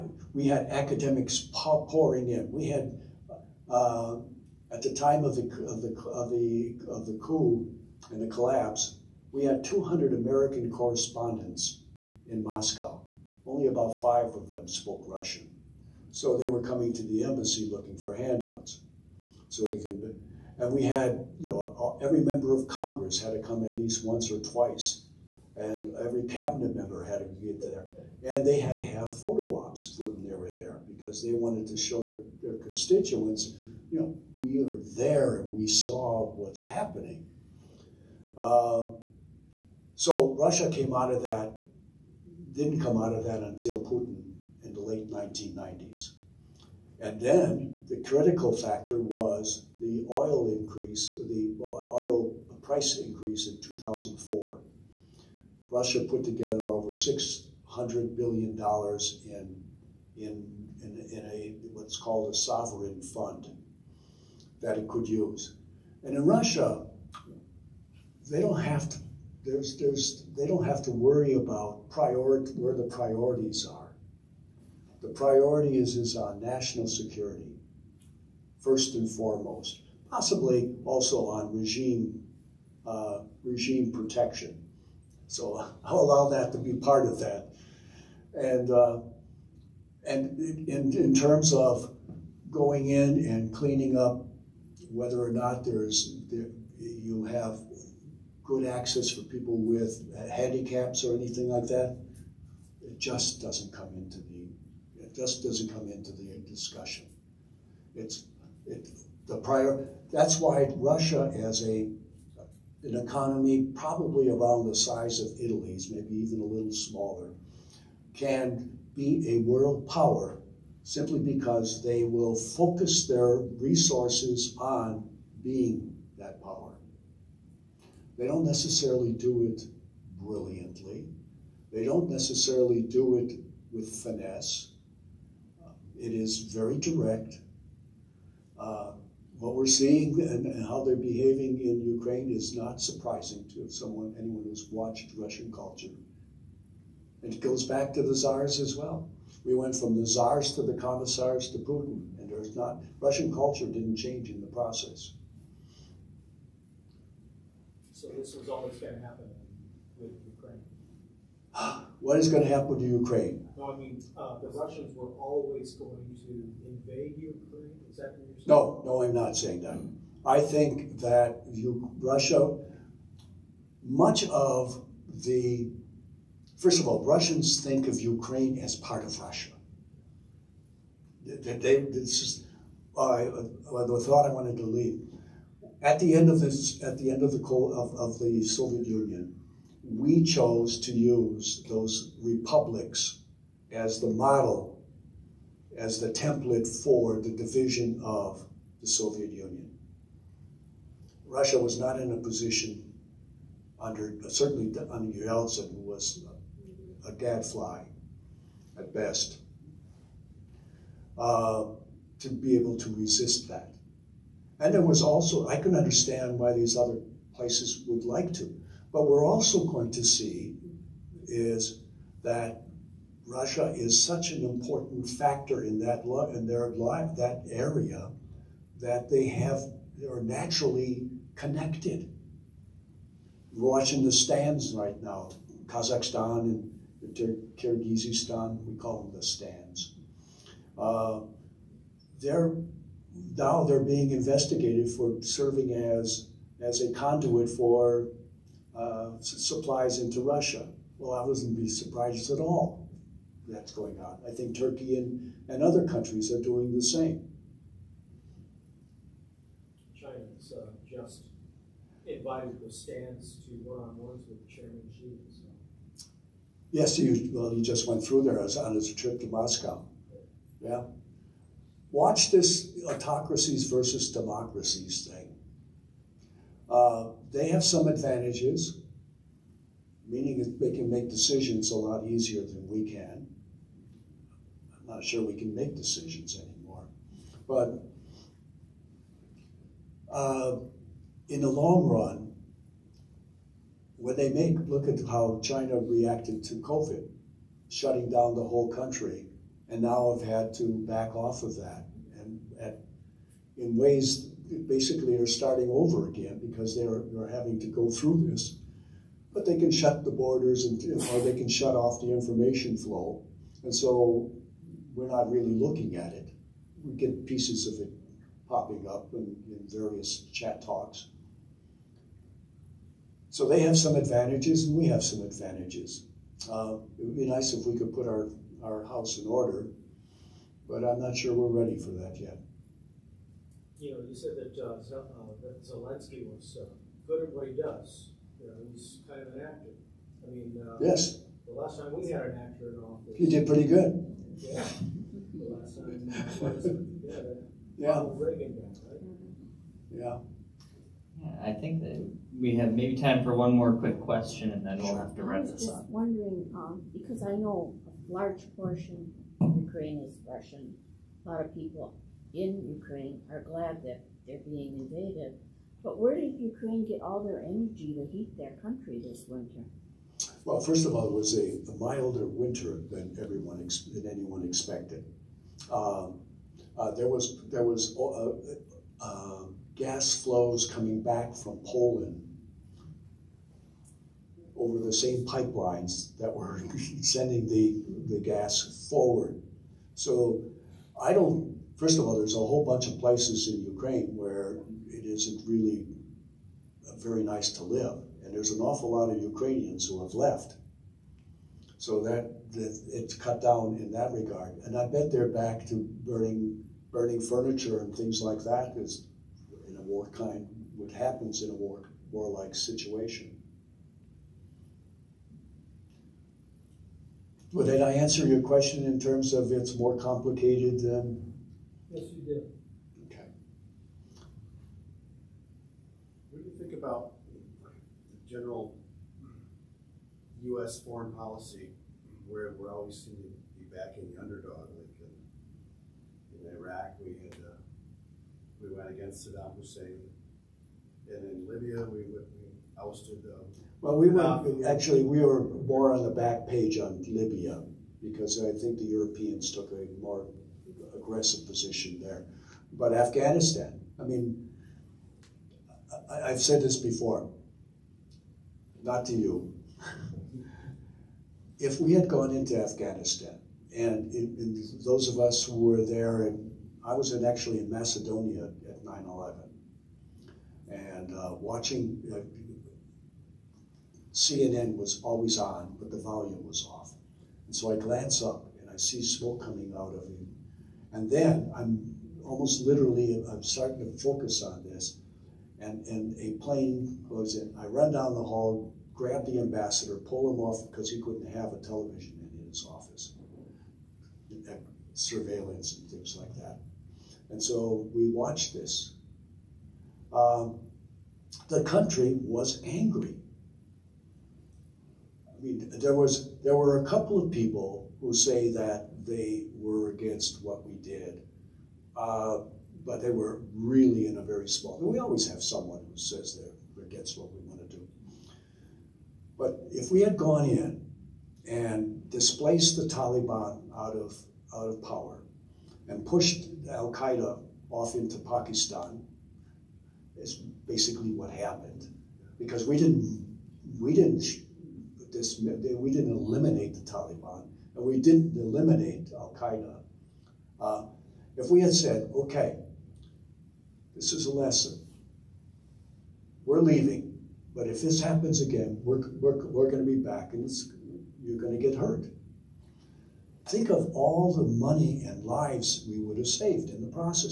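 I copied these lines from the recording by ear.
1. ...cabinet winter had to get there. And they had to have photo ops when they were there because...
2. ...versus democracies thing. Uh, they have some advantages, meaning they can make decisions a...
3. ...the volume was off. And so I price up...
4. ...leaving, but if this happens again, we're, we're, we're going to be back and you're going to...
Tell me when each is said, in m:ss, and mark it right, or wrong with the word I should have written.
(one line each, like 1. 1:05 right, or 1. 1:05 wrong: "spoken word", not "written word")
1. 0:26 wrong: "member", not "winter"
2. 4:33 right
3. 7:55 wrong: "glance", not "price"
4. 9:06 right.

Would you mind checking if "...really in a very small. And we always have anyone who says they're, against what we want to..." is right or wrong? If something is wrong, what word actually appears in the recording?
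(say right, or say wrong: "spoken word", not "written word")
wrong: "someone", not "anyone".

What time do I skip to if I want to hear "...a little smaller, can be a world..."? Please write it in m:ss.
1:56.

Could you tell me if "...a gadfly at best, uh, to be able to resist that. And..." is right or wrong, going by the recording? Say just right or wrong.
right.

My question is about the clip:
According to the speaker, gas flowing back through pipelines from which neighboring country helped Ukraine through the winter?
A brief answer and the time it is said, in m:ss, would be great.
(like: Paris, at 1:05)
Poland, at 6:21.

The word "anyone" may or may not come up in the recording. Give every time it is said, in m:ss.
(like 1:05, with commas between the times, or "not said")
2:24, 6:14.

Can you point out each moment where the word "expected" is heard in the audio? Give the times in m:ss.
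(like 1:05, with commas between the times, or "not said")
6:14.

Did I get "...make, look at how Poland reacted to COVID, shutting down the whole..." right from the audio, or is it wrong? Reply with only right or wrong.
wrong.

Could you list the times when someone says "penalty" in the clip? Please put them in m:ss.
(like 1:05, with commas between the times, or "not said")
not said.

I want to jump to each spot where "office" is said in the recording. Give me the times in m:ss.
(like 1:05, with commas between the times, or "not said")
5:42, 8:12.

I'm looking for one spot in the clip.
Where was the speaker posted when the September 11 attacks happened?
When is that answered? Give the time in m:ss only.
7:47.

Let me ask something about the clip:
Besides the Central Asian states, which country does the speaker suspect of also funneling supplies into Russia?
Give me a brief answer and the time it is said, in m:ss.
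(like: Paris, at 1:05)
Turkey, at 4:14.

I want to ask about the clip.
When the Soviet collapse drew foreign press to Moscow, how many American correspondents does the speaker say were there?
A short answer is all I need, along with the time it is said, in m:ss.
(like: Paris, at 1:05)
200, at 0:09.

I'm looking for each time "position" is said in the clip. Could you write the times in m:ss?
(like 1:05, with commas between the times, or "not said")
3:22, 7:31.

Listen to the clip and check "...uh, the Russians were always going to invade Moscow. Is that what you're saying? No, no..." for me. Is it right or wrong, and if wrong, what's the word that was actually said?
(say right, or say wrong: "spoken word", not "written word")
wrong: "Ukraine", not "Moscow".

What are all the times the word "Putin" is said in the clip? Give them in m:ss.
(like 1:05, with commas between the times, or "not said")
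0:43, 2:31.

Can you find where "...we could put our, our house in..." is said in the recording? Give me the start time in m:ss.
5:27.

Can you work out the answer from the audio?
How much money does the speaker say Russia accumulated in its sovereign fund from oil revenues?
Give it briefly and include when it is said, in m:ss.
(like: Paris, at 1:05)
over $600 billion, at 0:56.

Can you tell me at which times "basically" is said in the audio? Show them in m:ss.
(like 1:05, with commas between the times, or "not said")
5:04, 8:50.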